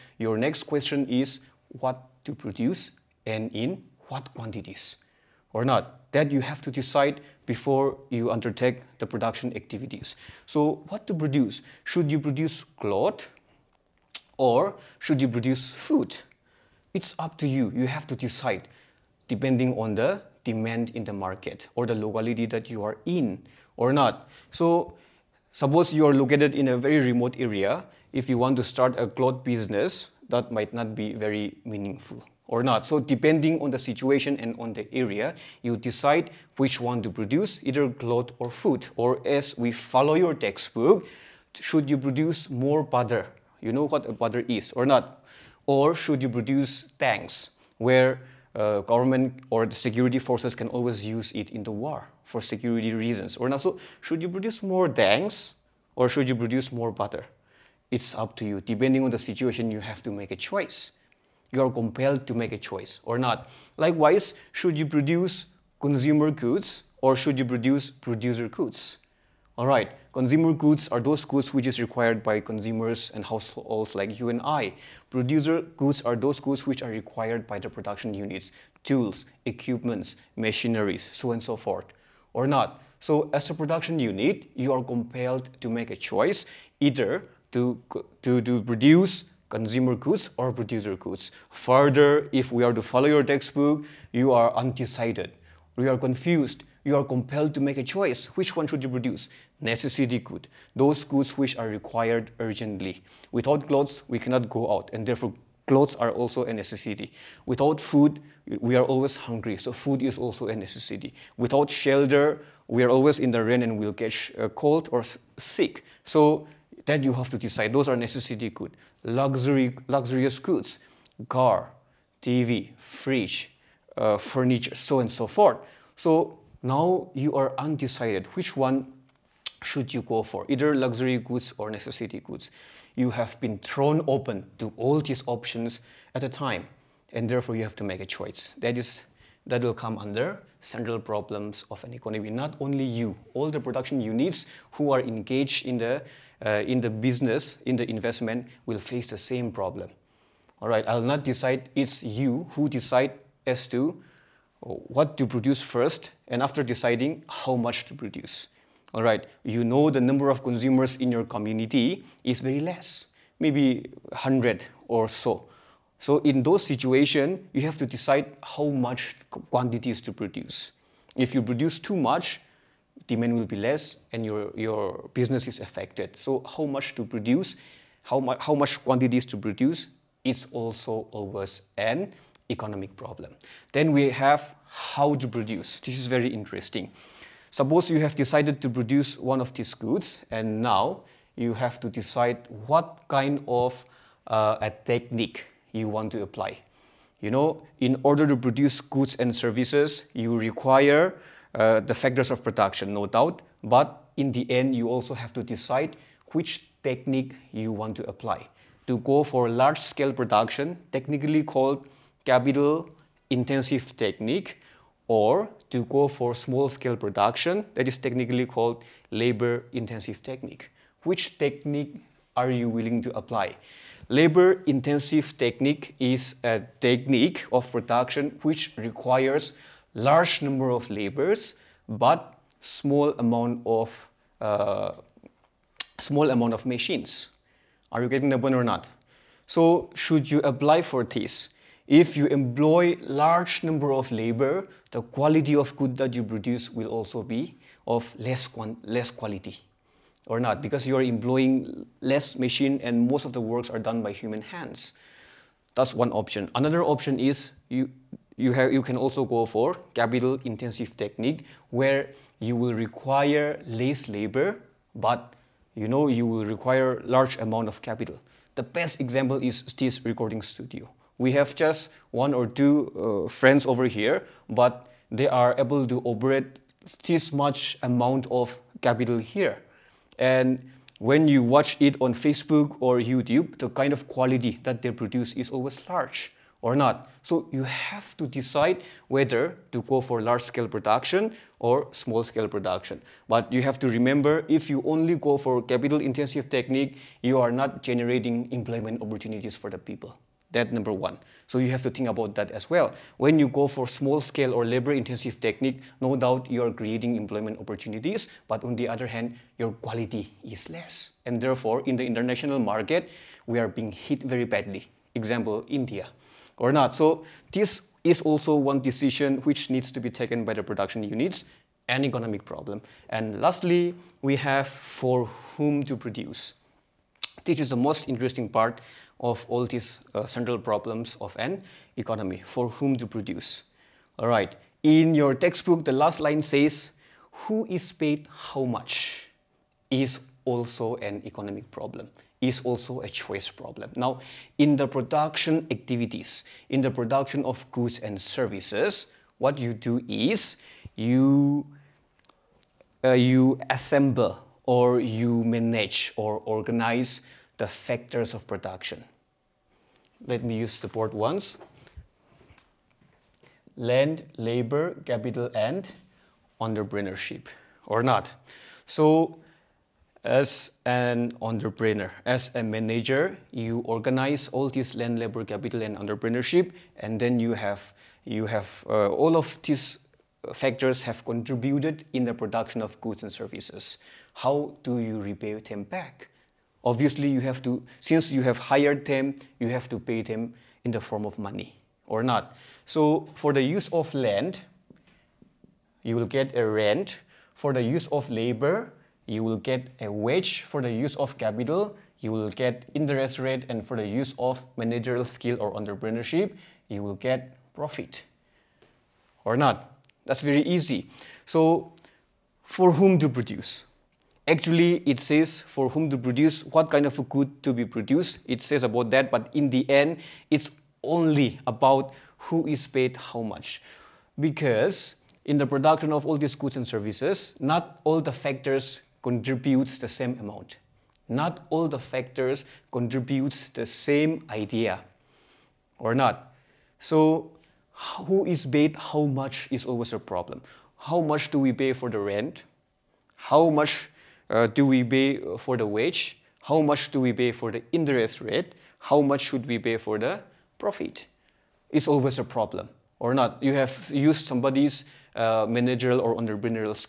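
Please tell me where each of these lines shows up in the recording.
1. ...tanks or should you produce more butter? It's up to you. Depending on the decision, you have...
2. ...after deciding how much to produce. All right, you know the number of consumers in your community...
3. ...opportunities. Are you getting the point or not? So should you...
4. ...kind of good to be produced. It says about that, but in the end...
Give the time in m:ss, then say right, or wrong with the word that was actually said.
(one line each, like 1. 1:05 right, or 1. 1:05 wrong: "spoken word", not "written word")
1. 0:54 wrong: "situation", not "decision"
2. 2:36 right
3. 3:56 wrong: "machines", not "opportunities"
4. 6:56 right.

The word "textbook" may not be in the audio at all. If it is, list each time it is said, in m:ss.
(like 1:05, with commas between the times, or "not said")
0:40, 1:33, 5:35.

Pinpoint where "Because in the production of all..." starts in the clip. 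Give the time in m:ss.
7:04.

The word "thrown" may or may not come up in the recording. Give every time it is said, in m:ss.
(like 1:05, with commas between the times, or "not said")
2:13.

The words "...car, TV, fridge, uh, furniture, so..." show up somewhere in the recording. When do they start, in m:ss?
2:01.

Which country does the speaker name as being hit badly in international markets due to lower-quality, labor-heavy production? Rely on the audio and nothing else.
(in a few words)
India.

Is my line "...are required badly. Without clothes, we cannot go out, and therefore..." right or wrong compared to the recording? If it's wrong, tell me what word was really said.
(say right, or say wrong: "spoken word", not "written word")
wrong: "urgently", not "badly".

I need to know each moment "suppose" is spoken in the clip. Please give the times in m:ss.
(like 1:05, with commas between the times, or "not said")
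0:25, 3:07.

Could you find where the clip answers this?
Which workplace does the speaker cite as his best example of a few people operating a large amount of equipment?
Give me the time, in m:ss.
4:30.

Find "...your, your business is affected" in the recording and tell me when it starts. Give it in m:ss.
2:54.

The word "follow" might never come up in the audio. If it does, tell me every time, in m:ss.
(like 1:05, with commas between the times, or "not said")
0:39, 1:32.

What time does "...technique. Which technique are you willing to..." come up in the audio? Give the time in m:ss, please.
3:40.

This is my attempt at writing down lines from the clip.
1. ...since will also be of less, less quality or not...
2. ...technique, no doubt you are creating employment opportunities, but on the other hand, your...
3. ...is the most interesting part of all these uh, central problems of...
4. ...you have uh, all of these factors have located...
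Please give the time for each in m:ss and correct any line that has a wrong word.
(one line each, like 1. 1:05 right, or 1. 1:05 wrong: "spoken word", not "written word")
1. 4:06 wrong: "produce", not "since"
2. 5:05 right
3. 5:27 right
4. 6:18 wrong: "contributed", not "located".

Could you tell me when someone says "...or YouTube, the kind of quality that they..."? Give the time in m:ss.
4:42.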